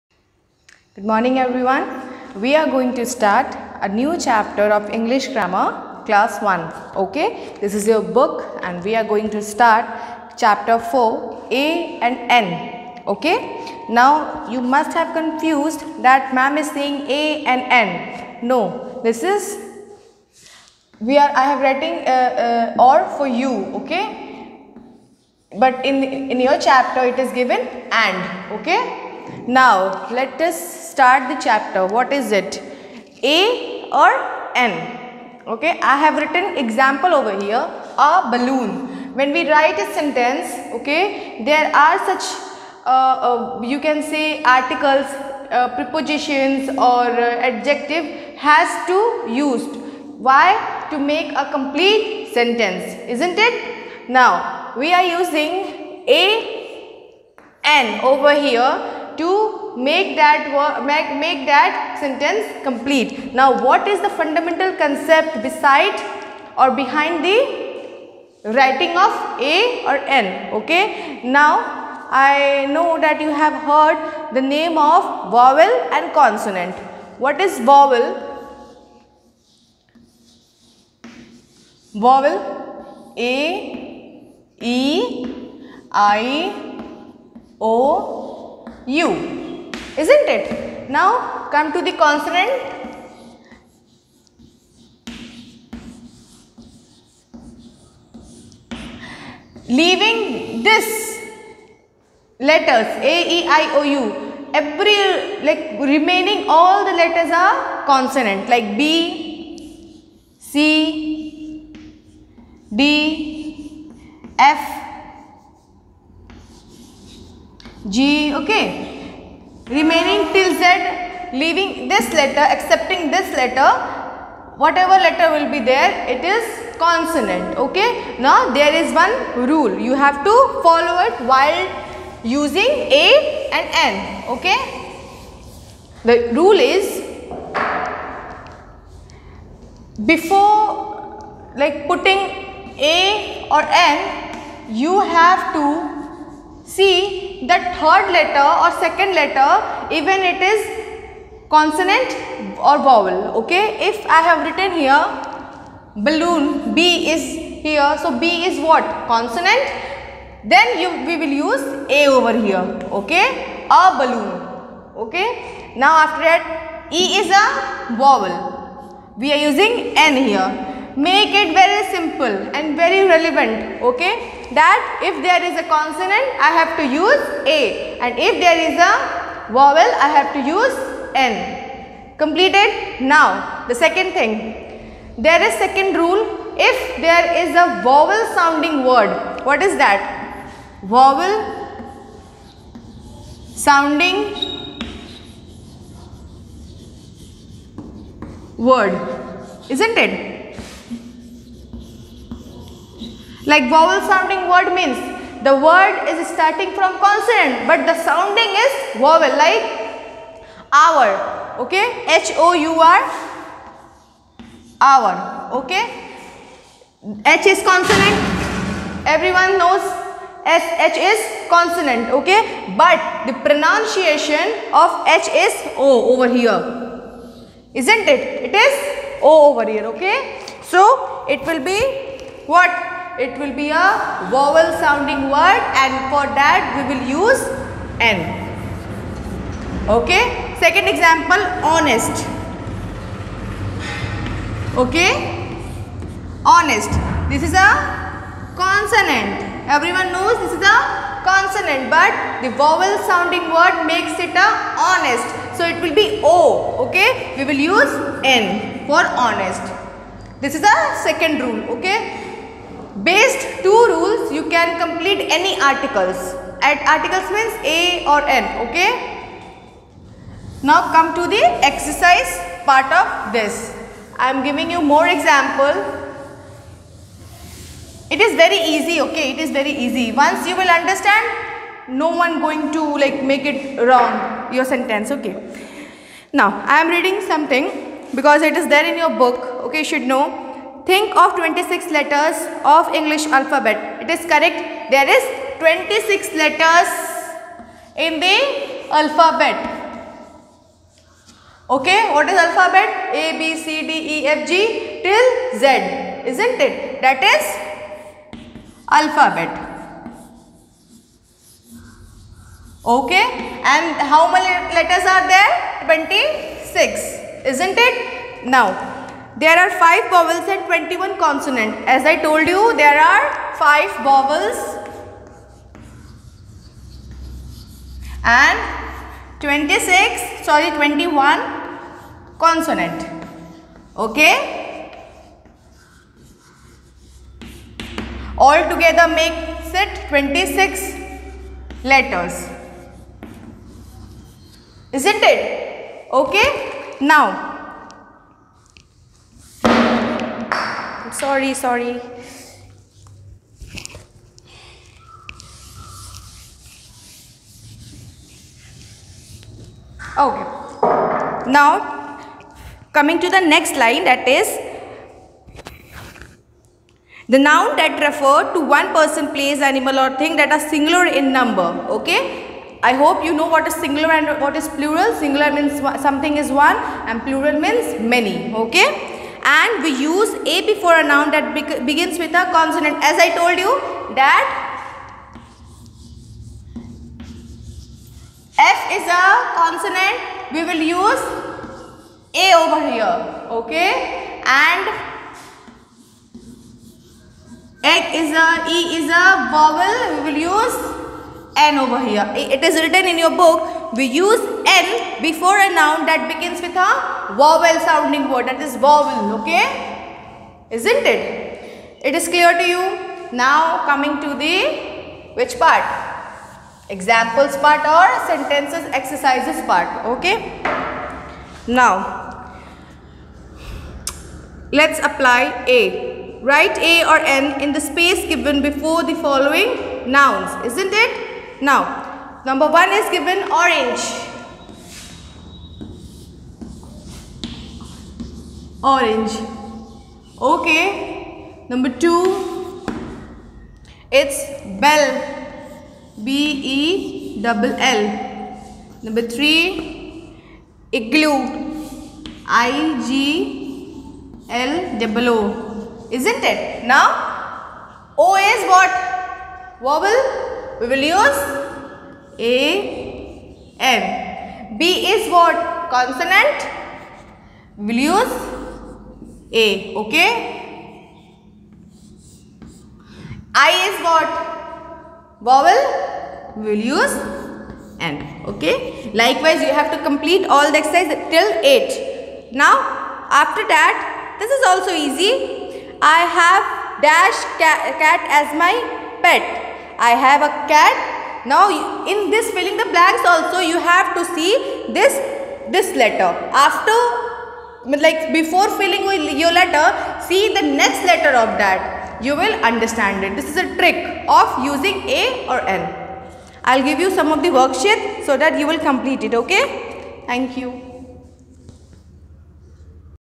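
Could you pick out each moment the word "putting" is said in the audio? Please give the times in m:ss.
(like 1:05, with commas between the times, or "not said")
2:21.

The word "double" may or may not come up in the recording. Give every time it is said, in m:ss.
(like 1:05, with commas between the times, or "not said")
7:27, 7:35.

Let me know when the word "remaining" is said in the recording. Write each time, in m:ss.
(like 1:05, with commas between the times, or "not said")
1:45, 1:59.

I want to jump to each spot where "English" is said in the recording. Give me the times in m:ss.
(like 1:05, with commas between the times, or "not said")
0:04, 4:52.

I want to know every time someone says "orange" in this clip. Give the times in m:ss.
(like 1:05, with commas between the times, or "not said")
7:13, 7:18.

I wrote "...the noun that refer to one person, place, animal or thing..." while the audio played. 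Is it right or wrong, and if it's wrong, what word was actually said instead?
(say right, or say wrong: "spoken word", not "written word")
right.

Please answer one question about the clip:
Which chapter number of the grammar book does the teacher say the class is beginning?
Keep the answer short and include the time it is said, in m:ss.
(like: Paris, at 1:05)
4, at 0:10.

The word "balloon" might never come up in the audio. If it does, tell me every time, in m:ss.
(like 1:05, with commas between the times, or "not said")
0:38, 2:36, 2:43.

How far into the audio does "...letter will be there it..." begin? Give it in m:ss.
2:05.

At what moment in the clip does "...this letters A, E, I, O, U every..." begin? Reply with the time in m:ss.
1:40.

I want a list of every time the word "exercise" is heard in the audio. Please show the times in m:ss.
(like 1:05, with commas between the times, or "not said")
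4:31, 6:59, 8:00.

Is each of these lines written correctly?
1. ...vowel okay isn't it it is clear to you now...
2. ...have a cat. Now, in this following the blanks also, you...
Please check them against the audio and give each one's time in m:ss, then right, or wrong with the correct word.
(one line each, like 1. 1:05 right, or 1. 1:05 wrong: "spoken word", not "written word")
1. 6:48 right
2. 8:10 wrong: "filling", not "following".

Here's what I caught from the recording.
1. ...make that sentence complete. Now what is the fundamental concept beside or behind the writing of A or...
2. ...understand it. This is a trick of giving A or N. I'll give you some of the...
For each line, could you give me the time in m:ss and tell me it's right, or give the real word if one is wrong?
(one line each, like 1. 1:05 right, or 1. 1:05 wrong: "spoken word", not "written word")
1. 1:01 right
2. 8:22 wrong: "using", not "giving".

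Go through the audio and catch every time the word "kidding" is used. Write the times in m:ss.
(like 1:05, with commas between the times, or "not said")
not said.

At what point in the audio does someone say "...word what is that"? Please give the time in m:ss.
3:08.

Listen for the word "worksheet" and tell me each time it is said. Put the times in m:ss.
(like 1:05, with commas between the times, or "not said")
8:27.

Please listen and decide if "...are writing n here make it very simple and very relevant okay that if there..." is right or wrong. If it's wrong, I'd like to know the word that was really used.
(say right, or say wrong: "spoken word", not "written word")
wrong: "using", not "writing".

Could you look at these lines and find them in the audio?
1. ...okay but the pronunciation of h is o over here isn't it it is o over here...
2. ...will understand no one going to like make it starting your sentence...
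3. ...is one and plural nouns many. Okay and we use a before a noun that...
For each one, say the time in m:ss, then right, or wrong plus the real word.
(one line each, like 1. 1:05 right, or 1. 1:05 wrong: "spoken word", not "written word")
1. 3:42 right
2. 4:40 wrong: "wrong", not "starting"
3. 6:16 wrong: "means", not "nouns".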